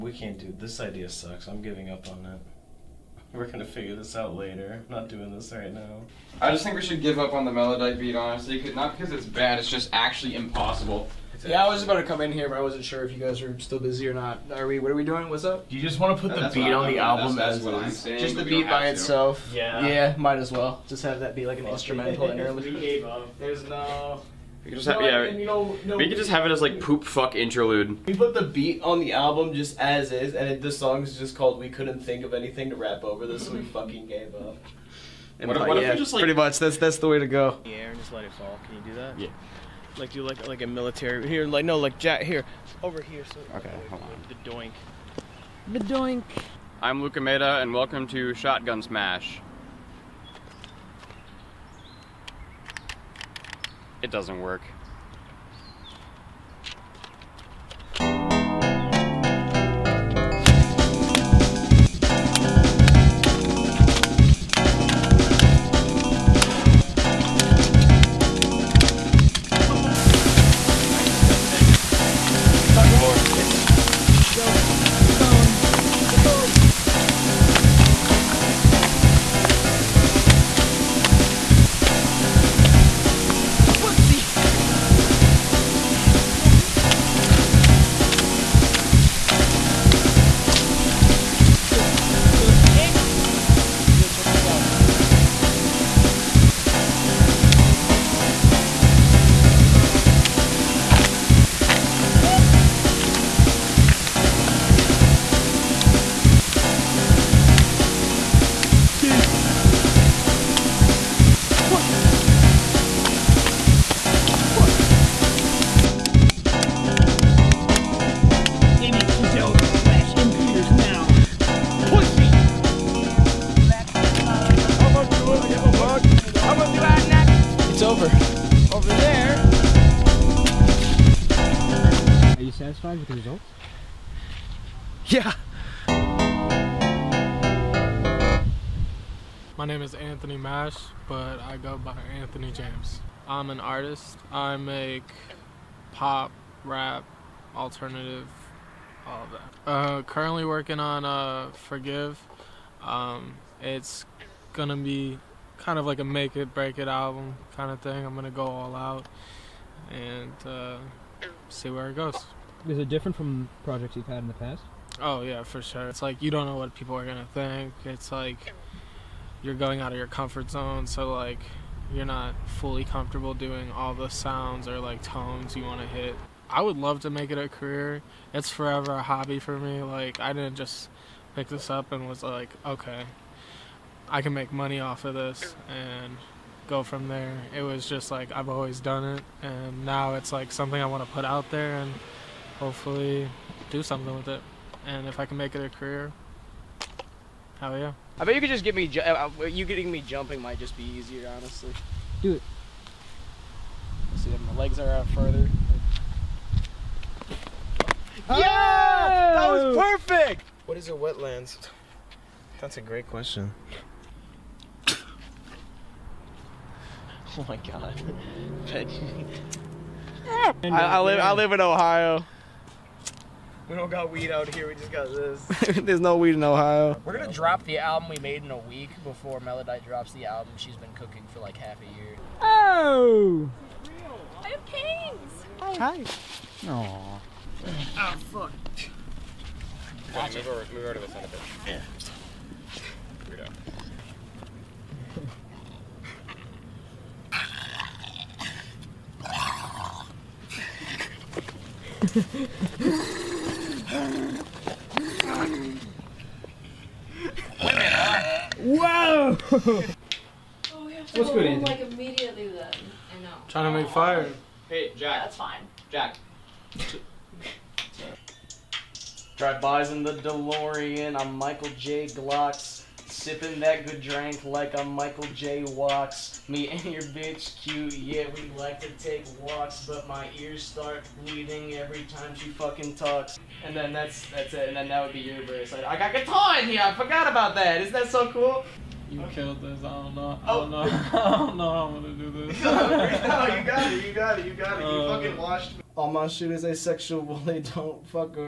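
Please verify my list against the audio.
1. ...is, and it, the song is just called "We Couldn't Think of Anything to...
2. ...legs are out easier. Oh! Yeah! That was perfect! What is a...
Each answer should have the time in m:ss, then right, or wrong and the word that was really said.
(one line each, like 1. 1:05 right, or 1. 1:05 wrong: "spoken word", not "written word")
1. 0:30 right
2. 3:24 wrong: "further", not "easier".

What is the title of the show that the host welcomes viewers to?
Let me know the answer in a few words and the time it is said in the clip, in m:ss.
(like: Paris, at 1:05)
Shotgun Smash, at 0:48.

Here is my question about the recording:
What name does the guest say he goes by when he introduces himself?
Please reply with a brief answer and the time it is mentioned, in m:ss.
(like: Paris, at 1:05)
Anthony James, at 2:22.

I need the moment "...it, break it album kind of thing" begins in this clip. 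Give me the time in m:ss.
2:36.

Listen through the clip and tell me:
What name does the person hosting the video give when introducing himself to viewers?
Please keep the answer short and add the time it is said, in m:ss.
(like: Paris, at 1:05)
Luca Mehta, at 0:47.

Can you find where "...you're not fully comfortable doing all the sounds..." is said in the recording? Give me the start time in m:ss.
2:51.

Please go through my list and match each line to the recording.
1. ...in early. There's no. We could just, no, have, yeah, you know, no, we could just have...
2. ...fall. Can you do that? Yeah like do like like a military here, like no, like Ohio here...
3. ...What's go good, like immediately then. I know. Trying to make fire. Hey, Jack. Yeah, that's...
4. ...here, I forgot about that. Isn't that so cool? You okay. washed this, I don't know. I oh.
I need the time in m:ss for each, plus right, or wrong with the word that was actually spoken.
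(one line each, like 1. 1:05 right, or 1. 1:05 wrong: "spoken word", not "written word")
1. 0:22 right
2. 0:38 wrong: "Jack", not "Ohio"
3. 4:21 right
4. 4:46 wrong: "killed", not "washed".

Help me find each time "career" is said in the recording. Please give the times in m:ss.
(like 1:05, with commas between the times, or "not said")
2:57, 3:15.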